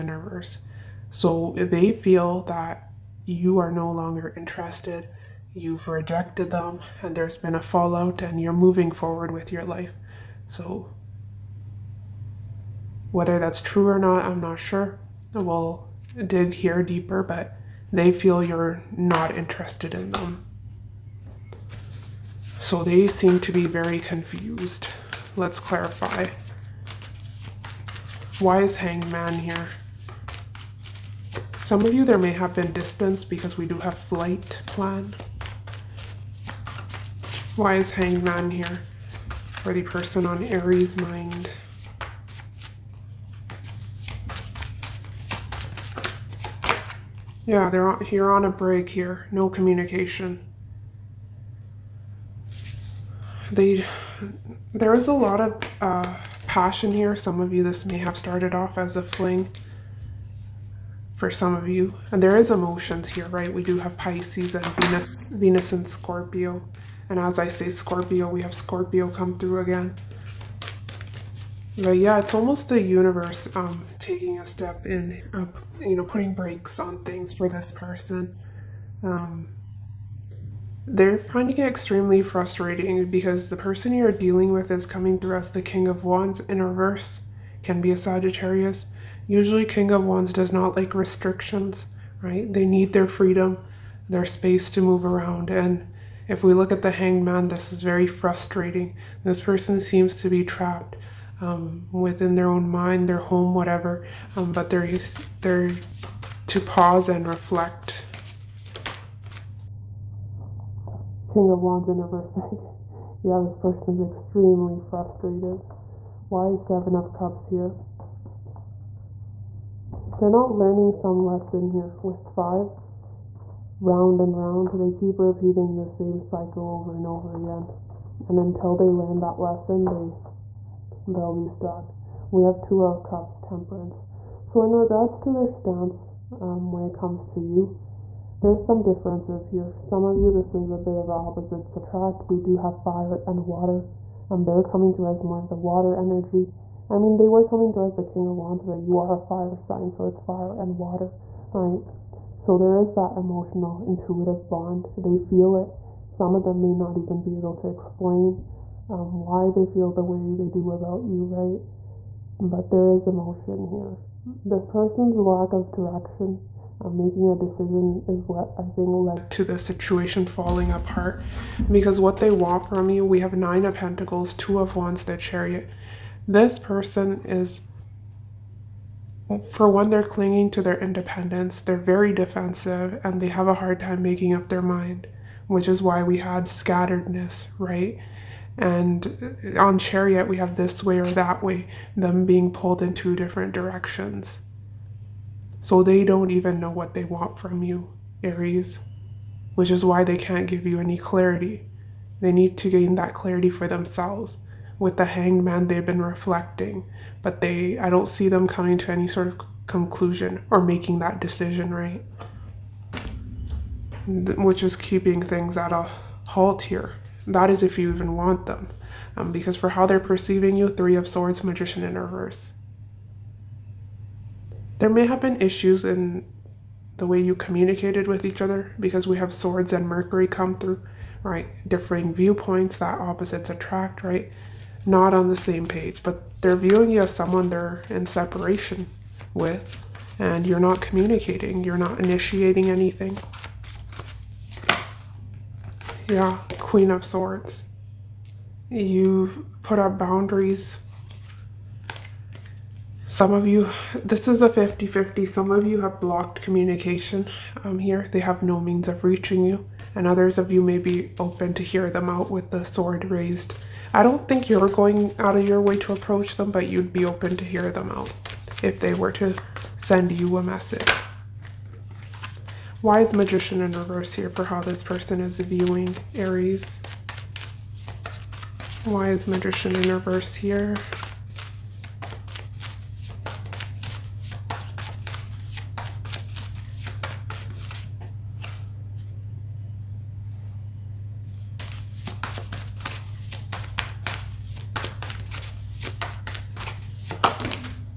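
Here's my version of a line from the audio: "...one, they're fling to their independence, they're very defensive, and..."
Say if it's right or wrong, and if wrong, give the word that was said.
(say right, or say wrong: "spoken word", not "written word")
wrong: "clinging", not "fling".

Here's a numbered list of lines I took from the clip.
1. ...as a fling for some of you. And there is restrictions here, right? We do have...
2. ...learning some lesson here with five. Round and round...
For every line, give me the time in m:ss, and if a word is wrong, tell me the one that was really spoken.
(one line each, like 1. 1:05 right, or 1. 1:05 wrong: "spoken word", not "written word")
1. 0:58 wrong: "emotions", not "restrictions"
2. 2:00 right.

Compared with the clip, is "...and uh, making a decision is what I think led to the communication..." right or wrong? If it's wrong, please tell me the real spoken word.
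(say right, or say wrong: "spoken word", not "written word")
wrong: "situation", not "communication".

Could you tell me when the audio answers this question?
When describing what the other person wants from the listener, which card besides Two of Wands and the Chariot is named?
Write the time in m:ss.
2:53.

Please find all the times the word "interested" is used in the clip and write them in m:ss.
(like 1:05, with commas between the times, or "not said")
0:04, 0:19.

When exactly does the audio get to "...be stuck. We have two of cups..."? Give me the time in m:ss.
2:11.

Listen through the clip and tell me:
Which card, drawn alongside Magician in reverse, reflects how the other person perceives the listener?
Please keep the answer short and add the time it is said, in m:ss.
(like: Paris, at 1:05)
Three of Swords, at 3:40.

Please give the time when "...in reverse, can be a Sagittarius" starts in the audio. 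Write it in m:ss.
1:26.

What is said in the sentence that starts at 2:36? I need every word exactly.
Some of them may not even be able to explain um, why they feel the way they do about you, right?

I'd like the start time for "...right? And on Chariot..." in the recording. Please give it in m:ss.
3:07.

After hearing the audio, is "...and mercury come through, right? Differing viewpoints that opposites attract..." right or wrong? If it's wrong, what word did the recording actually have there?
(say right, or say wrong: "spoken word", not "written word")
right.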